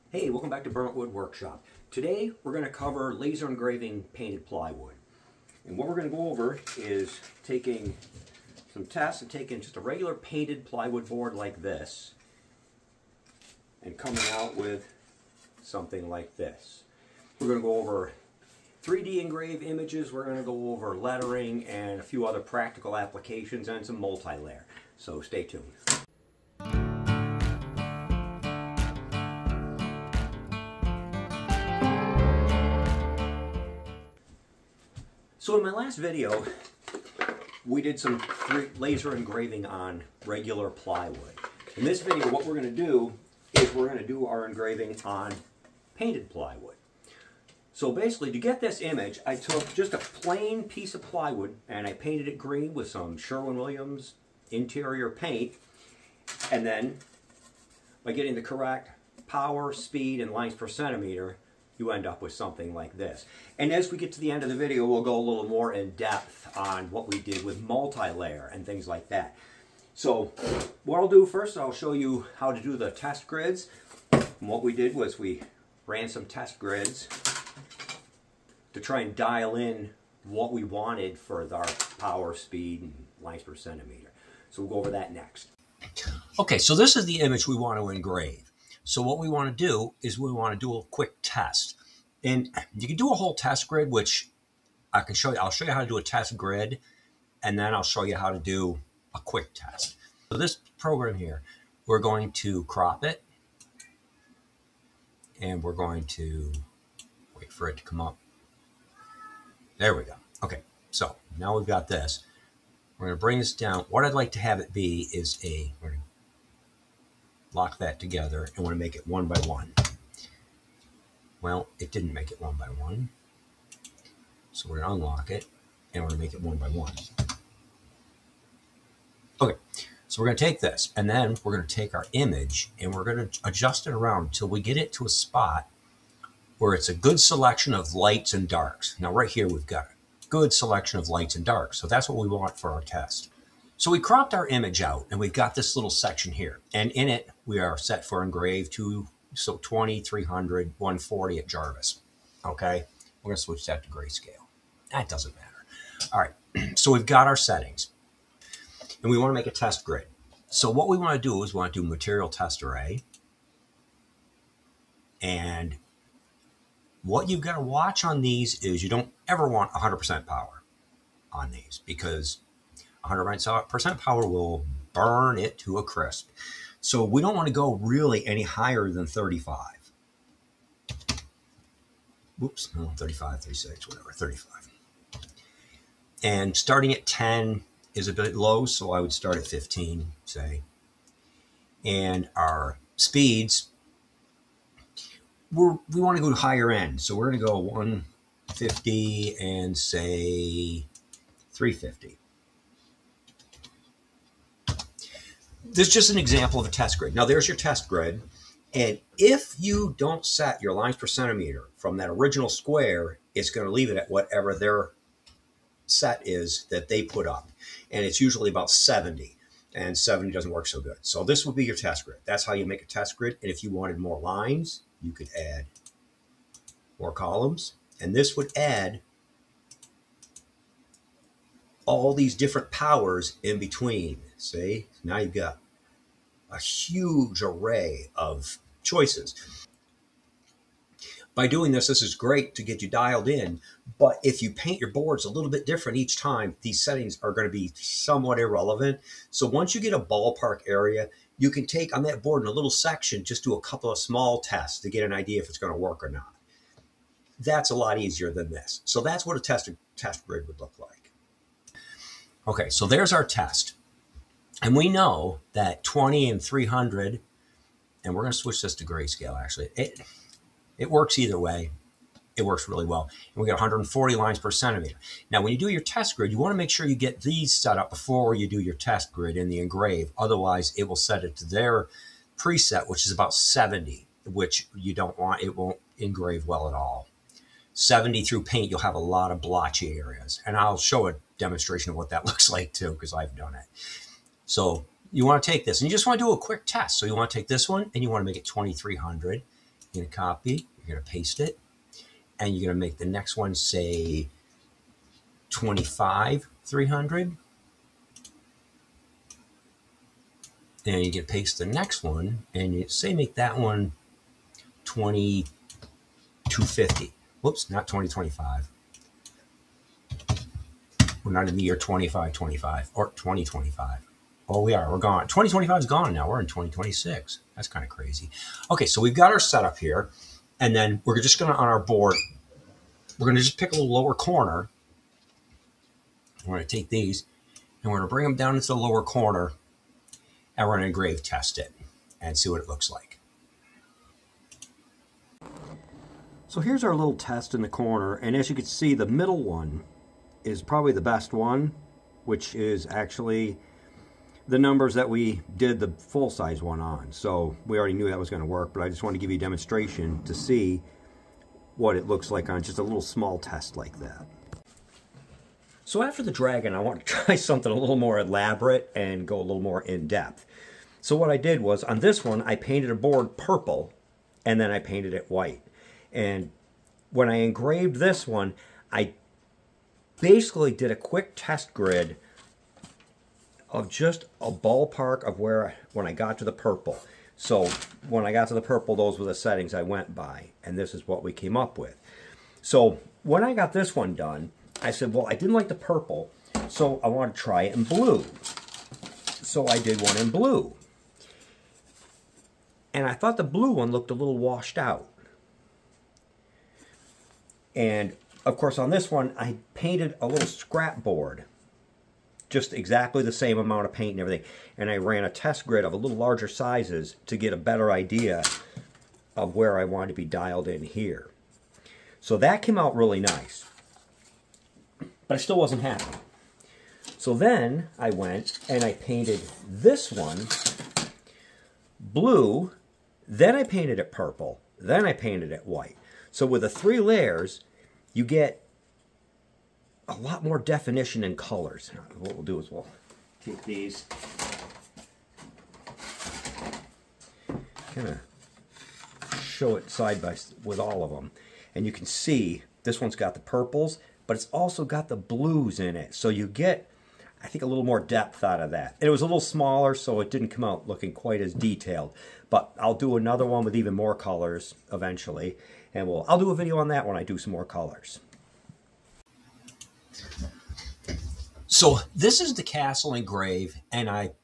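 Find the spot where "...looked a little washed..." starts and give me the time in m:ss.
6:43.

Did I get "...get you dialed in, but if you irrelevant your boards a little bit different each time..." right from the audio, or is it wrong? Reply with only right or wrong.
wrong.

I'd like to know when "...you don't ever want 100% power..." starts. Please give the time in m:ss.
2:48.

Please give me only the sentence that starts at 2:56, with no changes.
So we don't want to go really any higher than 35.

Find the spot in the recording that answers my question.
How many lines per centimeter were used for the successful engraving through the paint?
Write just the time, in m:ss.
4:33.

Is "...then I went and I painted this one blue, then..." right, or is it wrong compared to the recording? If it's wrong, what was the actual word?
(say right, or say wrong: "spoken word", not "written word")
right.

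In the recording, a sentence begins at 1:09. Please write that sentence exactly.
So what I'll do first, I'll show you how to do the test grids.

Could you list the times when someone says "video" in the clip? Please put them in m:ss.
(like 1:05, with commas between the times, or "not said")
0:35, 0:42, 1:04, 7:46.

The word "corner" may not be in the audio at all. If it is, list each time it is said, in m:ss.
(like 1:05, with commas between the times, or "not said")
5:34, 5:39, 5:47.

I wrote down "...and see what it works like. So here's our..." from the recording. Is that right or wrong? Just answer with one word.
wrong.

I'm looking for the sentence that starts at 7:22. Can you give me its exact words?
What we'll do is we'll take these, kind of show it side by with all of them.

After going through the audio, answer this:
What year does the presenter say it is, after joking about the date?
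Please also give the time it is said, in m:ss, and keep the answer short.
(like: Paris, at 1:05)
2026, at 5:26.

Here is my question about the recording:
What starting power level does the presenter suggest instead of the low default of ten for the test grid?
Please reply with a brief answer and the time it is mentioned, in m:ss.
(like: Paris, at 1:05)
15, at 3:09.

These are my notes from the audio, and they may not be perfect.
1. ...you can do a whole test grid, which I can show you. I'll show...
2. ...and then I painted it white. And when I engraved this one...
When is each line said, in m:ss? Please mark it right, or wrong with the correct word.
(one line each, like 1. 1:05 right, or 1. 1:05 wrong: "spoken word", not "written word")
1. 1:32 right
2. 6:14 right.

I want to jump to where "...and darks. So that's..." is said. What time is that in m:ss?
2:21.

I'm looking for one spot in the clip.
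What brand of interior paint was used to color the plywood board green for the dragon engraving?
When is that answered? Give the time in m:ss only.
0:53.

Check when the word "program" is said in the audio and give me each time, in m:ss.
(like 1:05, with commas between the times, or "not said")
1:40.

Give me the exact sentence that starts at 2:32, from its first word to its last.
Okay, we're gonna switch that to grayscale.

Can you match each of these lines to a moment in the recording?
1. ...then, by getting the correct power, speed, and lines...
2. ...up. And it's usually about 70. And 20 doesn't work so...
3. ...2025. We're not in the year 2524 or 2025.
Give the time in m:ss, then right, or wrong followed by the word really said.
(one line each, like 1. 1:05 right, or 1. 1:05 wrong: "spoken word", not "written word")
1. 0:56 right
2. 3:37 wrong: "70", not "20"
3. 5:17 wrong: "2525", not "2524".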